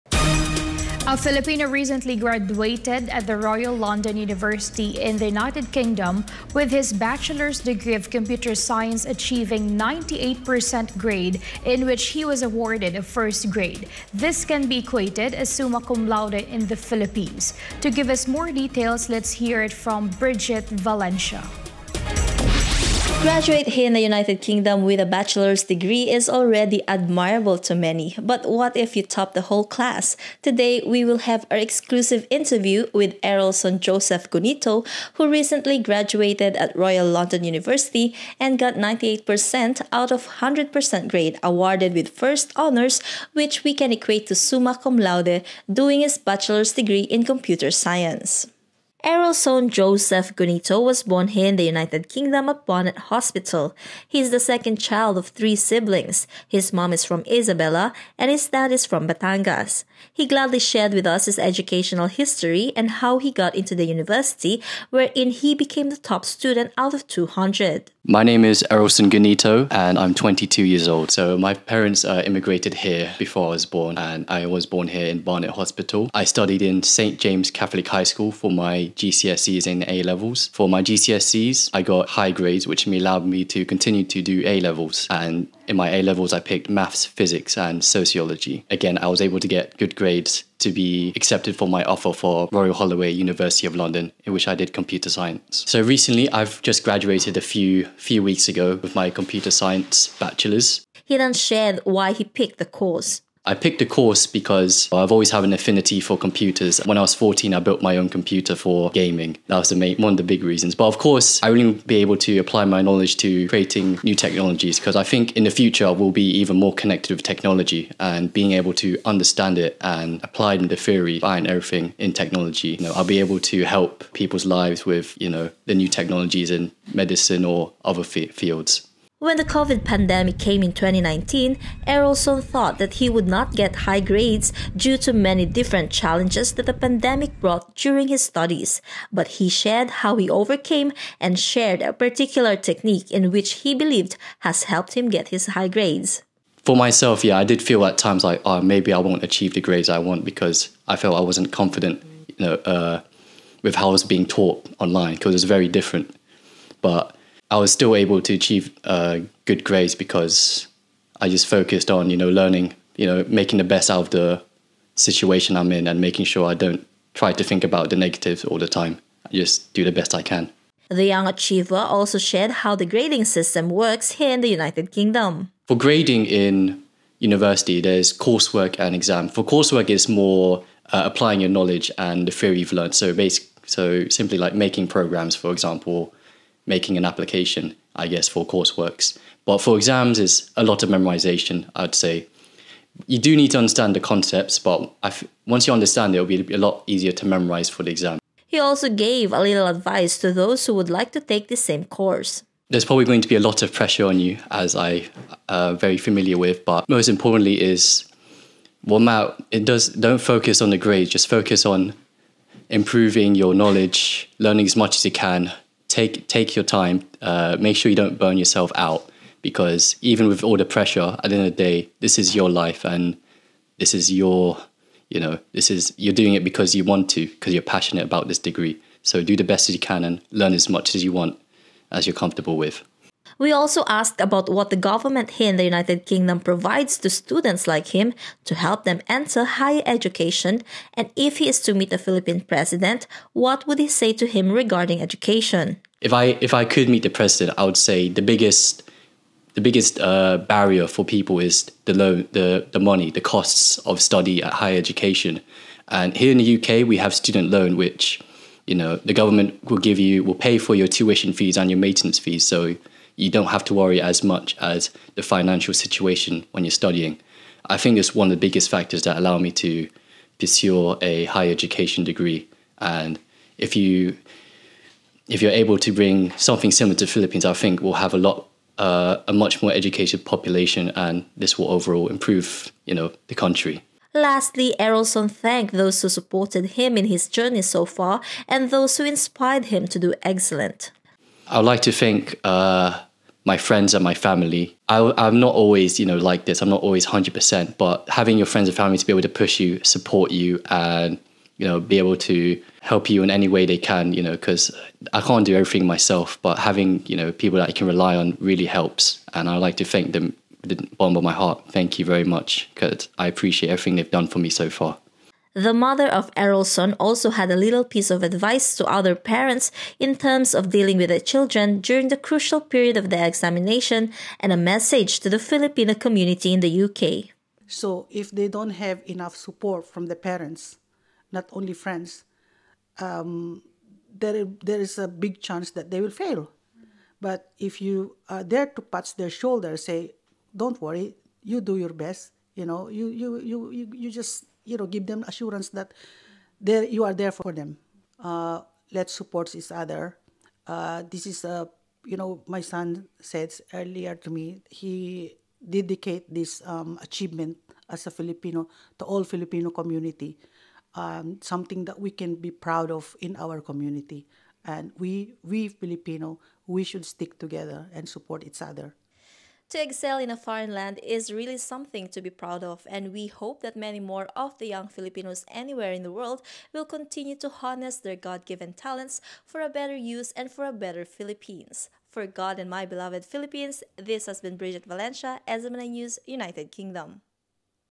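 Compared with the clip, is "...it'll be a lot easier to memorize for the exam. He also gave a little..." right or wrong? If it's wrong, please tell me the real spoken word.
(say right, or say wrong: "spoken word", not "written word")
right.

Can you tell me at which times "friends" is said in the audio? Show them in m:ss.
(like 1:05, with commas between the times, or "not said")
4:53, 4:58, 5:31.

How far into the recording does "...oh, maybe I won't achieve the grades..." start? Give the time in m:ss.
2:28.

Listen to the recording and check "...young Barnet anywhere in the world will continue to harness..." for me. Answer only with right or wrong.
wrong.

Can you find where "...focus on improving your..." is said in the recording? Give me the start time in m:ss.
3:31.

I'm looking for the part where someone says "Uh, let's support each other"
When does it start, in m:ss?
5:48.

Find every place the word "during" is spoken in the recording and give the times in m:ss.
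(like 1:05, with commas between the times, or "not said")
2:17, 5:21.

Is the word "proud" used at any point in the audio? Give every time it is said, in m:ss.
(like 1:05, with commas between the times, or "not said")
6:02, 6:12.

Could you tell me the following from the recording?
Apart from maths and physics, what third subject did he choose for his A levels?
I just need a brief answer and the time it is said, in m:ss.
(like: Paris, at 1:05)
sociology, at 1:27.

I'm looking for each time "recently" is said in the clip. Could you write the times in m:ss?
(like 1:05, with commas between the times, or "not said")
0:01, 0:35, 1:35.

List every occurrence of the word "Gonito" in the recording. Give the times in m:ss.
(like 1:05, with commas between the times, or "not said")
0:34, 0:50, 1:09.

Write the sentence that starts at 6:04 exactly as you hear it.
And we, we Filipino, we should stick together and support each other.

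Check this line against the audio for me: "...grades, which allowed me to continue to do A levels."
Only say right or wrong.
right.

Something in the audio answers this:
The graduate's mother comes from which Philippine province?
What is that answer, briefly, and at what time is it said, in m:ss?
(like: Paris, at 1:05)
Isabela, at 0:57.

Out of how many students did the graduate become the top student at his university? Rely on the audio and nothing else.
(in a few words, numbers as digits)
200.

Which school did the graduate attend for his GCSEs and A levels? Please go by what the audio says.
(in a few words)
St. James Catholic High School.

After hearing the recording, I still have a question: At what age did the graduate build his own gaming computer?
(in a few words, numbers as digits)
14.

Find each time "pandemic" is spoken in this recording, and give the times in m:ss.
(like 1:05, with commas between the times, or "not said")
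2:09, 2:16.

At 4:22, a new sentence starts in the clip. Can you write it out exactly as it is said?
So you don't have to worry as much as the financial situation when you're studying.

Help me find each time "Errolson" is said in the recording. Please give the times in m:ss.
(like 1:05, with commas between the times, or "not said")
0:33, 0:49, 1:08, 2:11, 4:44, 5:16.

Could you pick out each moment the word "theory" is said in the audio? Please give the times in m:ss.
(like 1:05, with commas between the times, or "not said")
2:00, 3:02.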